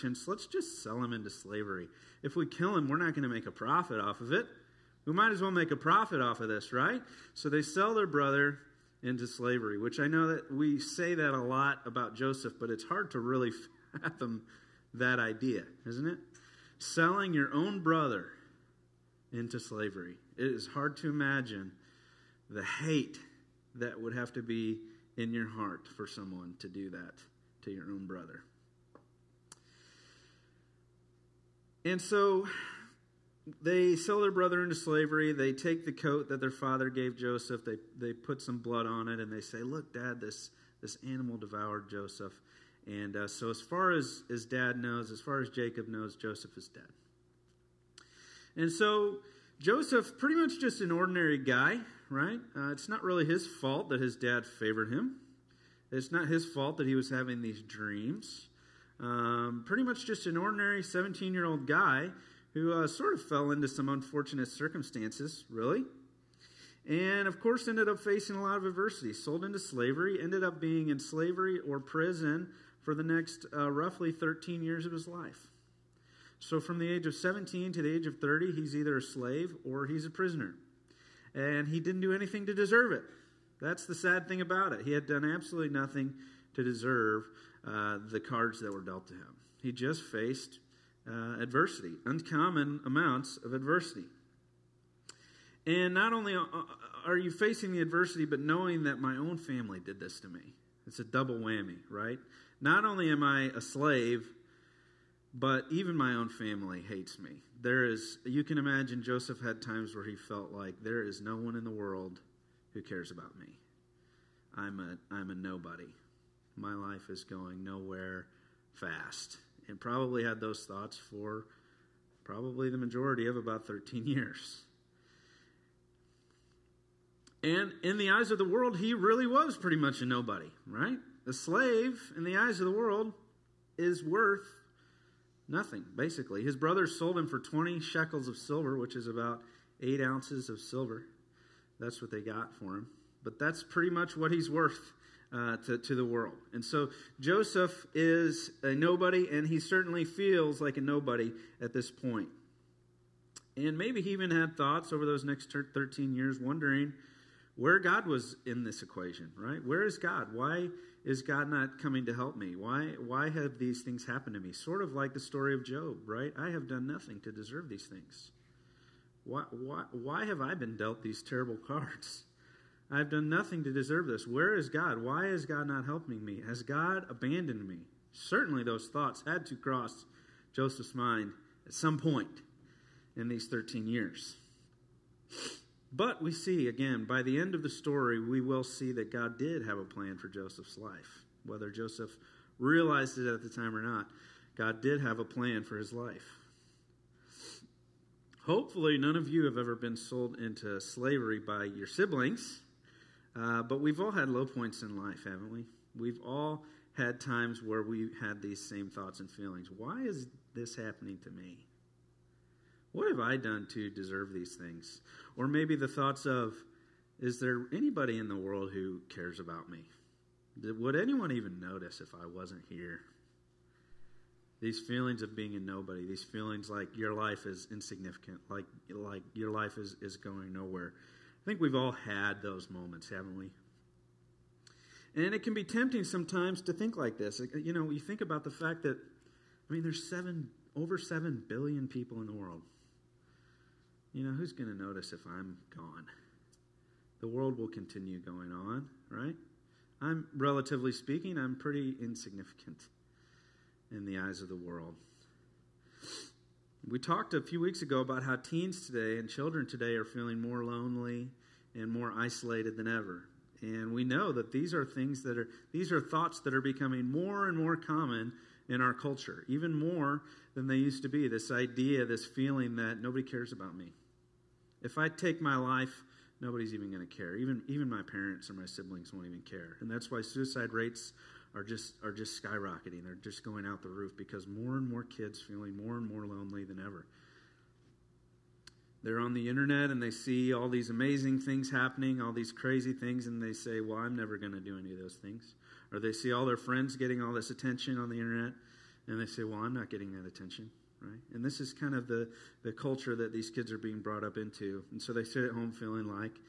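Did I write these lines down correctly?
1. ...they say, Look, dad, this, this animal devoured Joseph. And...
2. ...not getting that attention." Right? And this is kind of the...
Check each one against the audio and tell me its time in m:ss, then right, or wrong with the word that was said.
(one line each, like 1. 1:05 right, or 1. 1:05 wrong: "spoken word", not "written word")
1. 0:39 right
2. 4:59 right.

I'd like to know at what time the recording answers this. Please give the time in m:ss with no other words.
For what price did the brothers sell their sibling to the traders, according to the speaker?
2:17.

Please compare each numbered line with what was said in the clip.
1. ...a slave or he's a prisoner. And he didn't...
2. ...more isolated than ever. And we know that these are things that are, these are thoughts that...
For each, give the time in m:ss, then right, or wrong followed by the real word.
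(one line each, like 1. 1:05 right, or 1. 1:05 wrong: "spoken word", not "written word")
1. 1:18 right
2. 4:21 right.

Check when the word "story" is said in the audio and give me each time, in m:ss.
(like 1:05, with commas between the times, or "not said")
2:45, 3:07.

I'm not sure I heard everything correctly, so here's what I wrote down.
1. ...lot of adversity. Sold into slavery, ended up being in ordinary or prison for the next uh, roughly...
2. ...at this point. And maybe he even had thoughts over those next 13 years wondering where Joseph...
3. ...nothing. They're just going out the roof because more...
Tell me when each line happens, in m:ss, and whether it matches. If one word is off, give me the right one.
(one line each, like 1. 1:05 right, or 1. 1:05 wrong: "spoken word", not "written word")
1. 1:08 wrong: "slavery", not "ordinary"
2. 2:31 wrong: "God", not "Joseph"
3. 4:42 wrong: "skyrocketing", not "nothing".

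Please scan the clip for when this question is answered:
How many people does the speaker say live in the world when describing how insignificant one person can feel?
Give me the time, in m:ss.
4:00.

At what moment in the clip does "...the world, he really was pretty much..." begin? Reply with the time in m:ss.
2:08.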